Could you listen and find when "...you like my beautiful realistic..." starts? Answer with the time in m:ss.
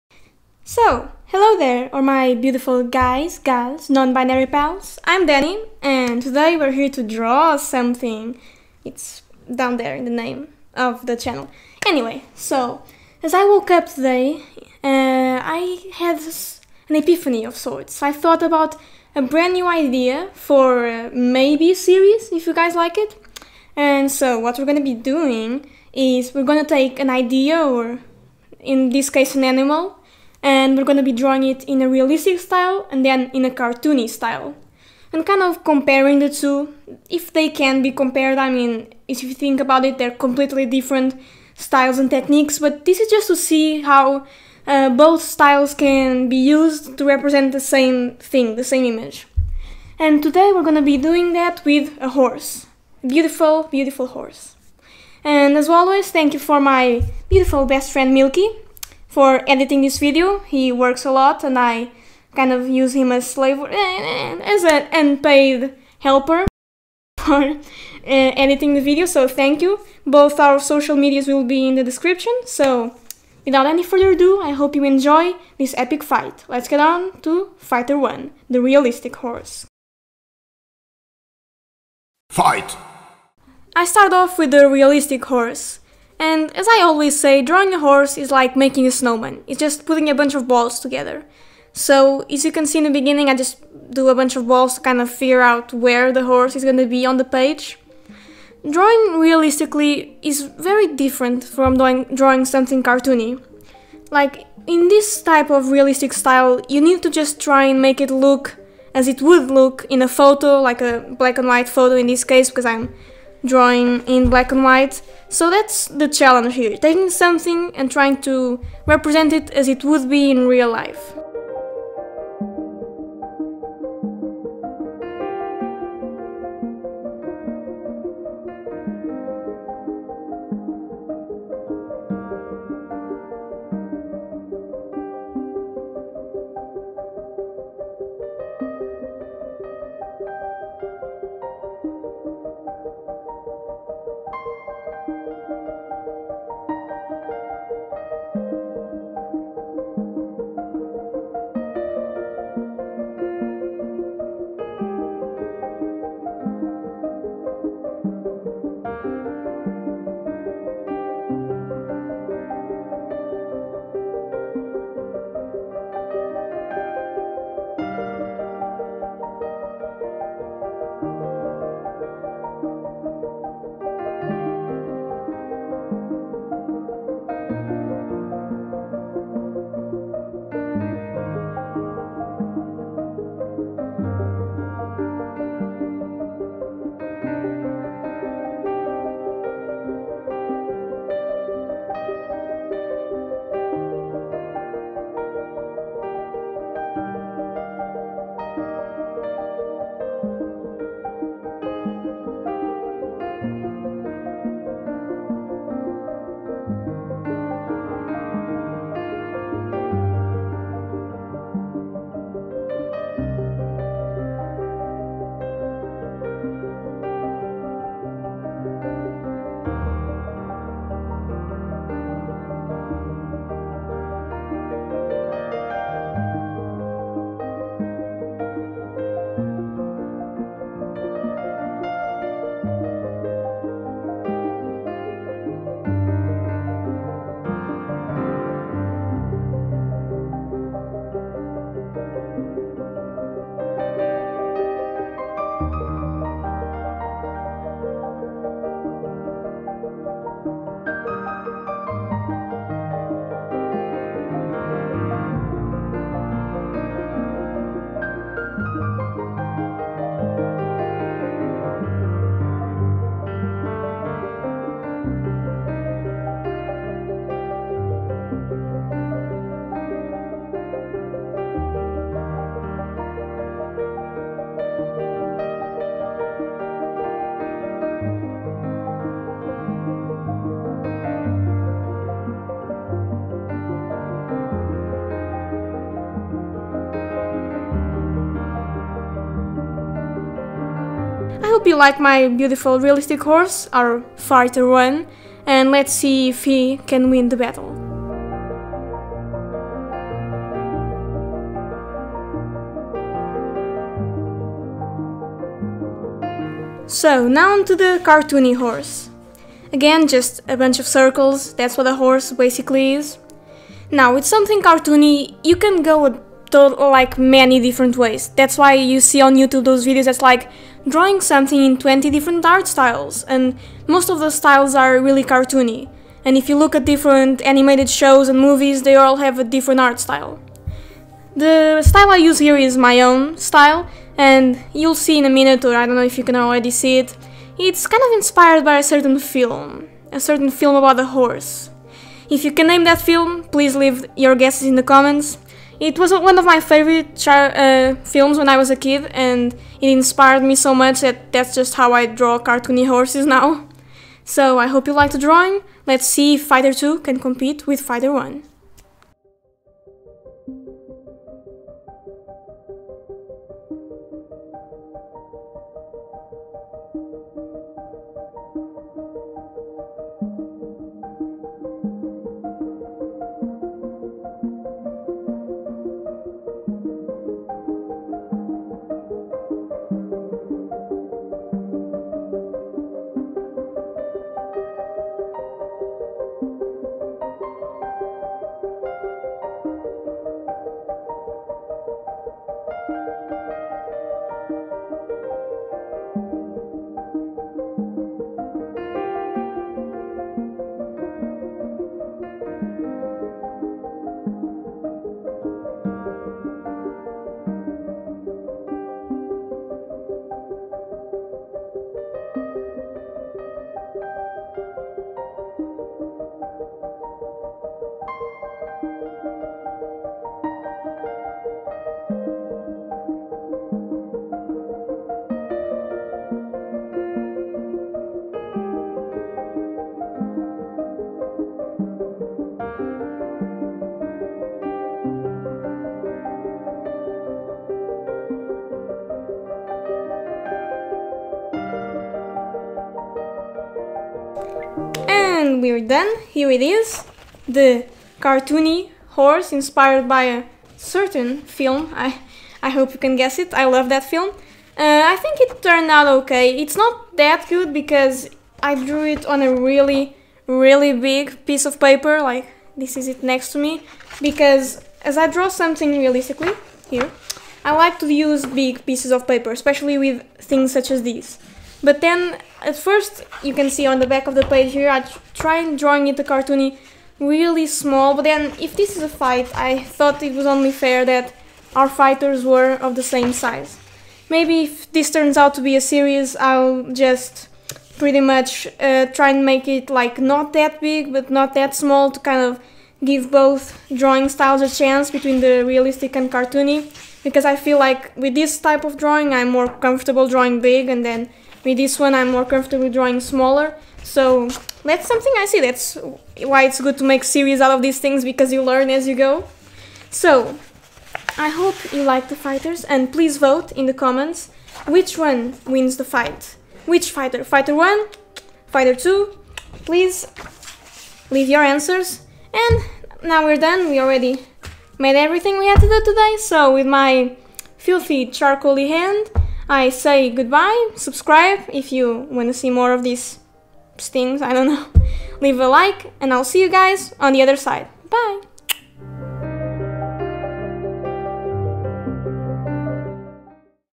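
4:51.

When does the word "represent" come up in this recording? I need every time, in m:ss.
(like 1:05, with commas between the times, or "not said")
0:47, 1:58.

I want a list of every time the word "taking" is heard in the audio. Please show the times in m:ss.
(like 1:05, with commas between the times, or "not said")
1:56.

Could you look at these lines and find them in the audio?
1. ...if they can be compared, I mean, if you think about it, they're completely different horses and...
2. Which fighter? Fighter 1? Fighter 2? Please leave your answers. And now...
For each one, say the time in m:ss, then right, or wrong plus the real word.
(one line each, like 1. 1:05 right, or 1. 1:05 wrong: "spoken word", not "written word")
1. 0:37 wrong: "styles", not "horses"
2. 8:36 right.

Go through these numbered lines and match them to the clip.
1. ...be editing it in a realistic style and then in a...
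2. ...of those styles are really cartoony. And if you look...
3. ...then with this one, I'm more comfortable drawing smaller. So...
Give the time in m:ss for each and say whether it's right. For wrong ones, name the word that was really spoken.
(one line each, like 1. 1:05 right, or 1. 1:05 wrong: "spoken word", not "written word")
1. 0:31 wrong: "drawing", not "editing"
2. 5:24 right
3. 8:21 right.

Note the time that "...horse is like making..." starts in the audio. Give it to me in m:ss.
1:27.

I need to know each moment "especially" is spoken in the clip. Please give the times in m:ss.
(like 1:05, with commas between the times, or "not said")
7:49.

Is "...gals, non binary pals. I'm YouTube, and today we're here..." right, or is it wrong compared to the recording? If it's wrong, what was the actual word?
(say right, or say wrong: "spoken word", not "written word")
wrong: "Denny", not "YouTube".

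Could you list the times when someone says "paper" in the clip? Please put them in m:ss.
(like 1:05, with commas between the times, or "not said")
7:41, 7:49.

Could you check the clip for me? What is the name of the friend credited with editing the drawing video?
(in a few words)
Milky.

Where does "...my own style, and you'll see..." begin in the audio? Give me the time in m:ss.
5:32.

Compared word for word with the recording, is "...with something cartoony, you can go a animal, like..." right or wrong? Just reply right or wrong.
wrong.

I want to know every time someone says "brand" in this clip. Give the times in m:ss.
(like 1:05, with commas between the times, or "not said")
0:19.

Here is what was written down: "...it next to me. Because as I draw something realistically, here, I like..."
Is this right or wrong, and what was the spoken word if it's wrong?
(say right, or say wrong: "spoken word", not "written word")
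right.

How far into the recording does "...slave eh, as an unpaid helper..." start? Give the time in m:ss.
1:03.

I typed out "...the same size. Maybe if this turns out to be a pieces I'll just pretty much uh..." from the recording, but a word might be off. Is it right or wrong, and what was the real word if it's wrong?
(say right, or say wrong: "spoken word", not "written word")
wrong: "series", not "pieces".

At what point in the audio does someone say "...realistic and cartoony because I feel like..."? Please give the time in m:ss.
8:15.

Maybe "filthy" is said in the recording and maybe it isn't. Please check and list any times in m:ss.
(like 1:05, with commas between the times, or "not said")
8:47.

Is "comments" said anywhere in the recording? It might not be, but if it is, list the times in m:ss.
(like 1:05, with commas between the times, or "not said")
5:44, 8:33.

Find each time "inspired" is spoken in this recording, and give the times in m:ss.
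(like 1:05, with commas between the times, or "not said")
5:38, 5:49, 7:29.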